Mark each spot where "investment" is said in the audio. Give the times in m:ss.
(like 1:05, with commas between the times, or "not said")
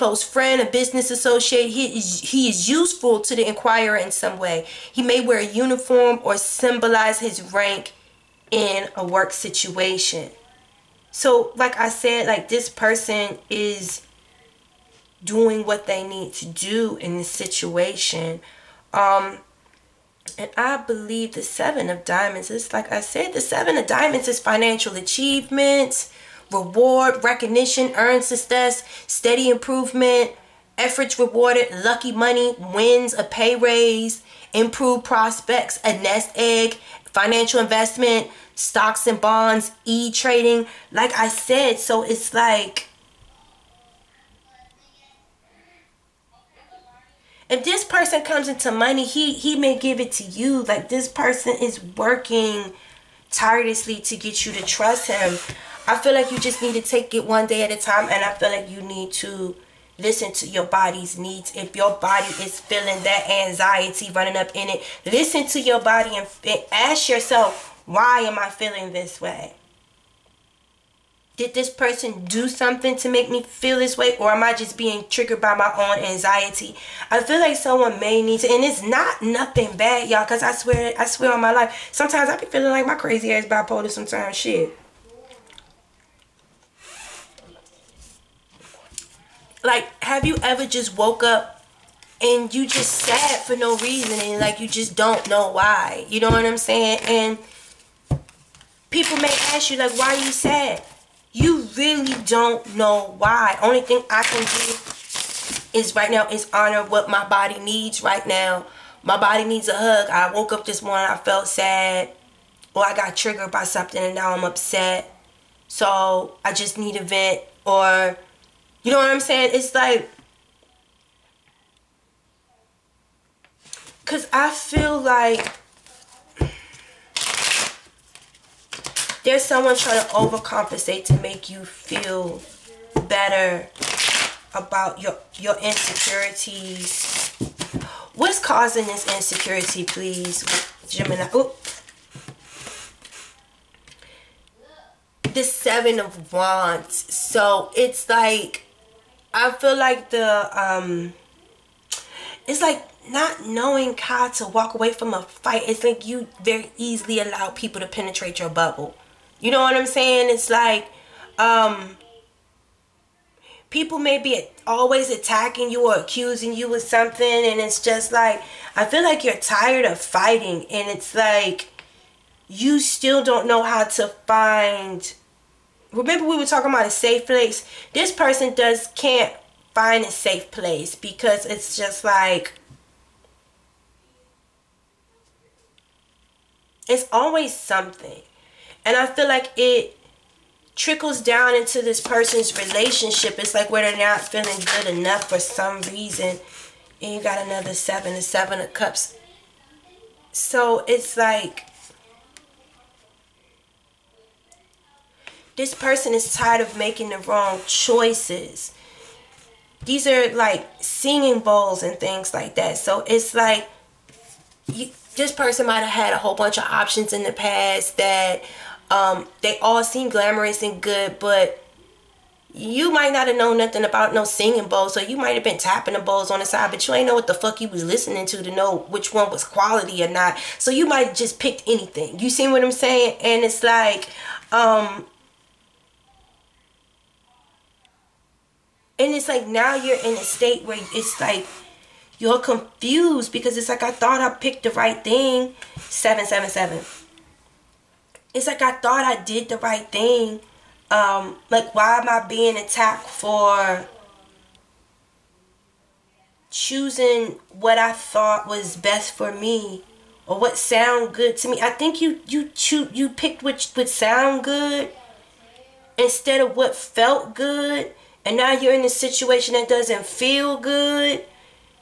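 0:37.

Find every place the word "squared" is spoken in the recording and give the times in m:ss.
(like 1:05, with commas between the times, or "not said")
not said.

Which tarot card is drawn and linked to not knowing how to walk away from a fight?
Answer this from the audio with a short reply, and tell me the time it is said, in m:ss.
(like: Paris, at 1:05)
Seven of Wands, at 2:25.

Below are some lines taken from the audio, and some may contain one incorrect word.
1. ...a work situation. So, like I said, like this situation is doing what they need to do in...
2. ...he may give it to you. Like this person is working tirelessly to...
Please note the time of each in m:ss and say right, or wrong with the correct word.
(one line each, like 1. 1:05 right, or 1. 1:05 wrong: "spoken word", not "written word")
1. 0:08 wrong: "person", not "situation"
2. 0:49 right.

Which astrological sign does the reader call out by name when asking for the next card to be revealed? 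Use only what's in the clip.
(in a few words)
Gemini.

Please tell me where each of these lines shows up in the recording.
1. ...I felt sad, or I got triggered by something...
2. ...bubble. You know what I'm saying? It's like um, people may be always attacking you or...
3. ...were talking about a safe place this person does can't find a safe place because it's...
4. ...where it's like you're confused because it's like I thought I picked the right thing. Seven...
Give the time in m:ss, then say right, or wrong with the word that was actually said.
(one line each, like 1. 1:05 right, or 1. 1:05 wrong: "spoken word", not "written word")
1. 1:51 right
2. 2:38 right
3. 2:56 right
4. 4:00 right.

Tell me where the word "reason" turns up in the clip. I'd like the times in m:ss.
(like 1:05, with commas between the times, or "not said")
1:33, 3:15.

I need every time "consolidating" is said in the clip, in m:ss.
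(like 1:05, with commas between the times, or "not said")
not said.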